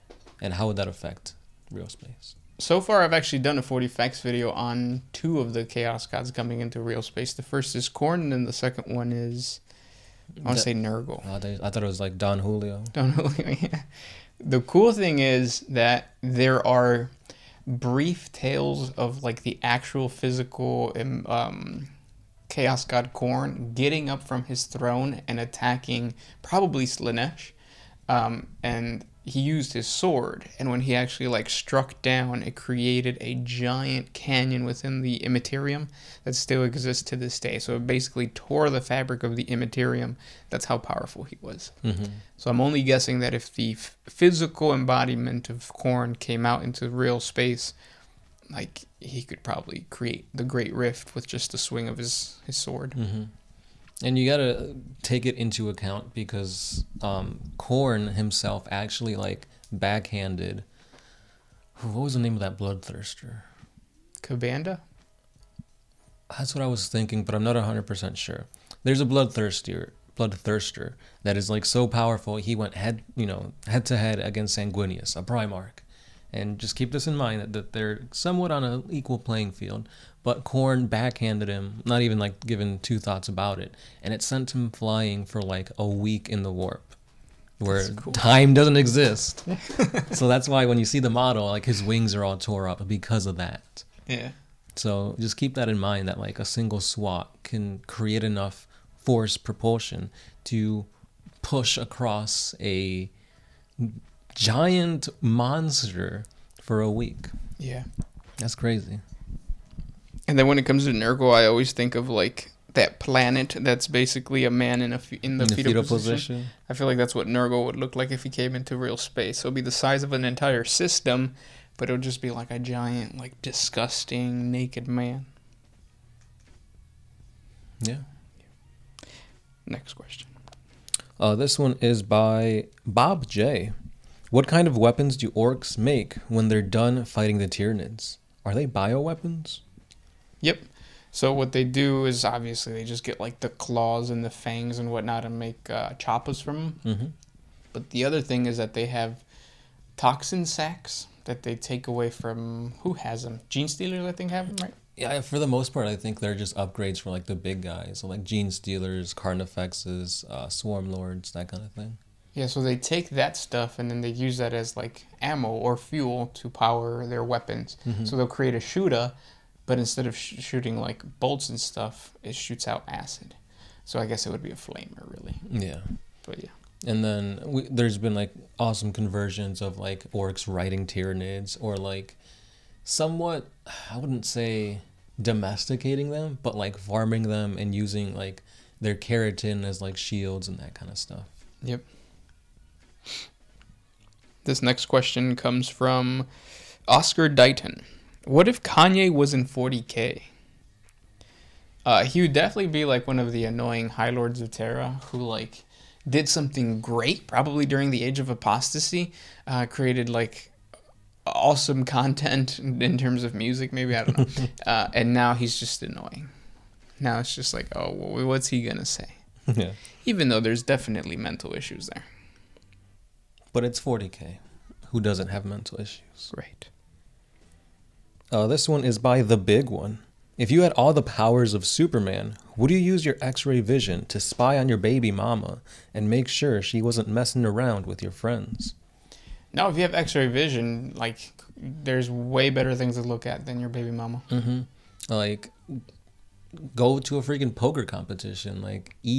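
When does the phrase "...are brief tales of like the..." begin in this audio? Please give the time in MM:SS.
00:16.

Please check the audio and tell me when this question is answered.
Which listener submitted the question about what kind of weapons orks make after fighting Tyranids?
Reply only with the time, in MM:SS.
02:12.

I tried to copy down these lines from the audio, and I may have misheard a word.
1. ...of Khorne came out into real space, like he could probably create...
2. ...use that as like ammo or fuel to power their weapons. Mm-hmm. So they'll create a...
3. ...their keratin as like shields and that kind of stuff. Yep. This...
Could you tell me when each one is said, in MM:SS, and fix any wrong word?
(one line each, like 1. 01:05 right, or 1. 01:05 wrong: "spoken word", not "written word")
1. 00:45 right
2. 02:44 right
3. 03:08 right.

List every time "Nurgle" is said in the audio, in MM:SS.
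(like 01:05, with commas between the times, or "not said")
00:10, 01:50, 01:57.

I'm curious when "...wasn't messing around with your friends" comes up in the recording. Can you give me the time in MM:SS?
03:56.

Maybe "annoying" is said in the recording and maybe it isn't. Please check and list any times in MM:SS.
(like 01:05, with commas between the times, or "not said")
03:23, 03:35.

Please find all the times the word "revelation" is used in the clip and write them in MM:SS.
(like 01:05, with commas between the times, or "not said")
not said.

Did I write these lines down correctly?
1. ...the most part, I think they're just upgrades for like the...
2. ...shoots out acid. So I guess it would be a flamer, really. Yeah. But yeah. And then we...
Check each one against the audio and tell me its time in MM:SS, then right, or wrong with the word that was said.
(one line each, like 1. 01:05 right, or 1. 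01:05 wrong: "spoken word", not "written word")
1. 02:35 right
2. 02:52 right.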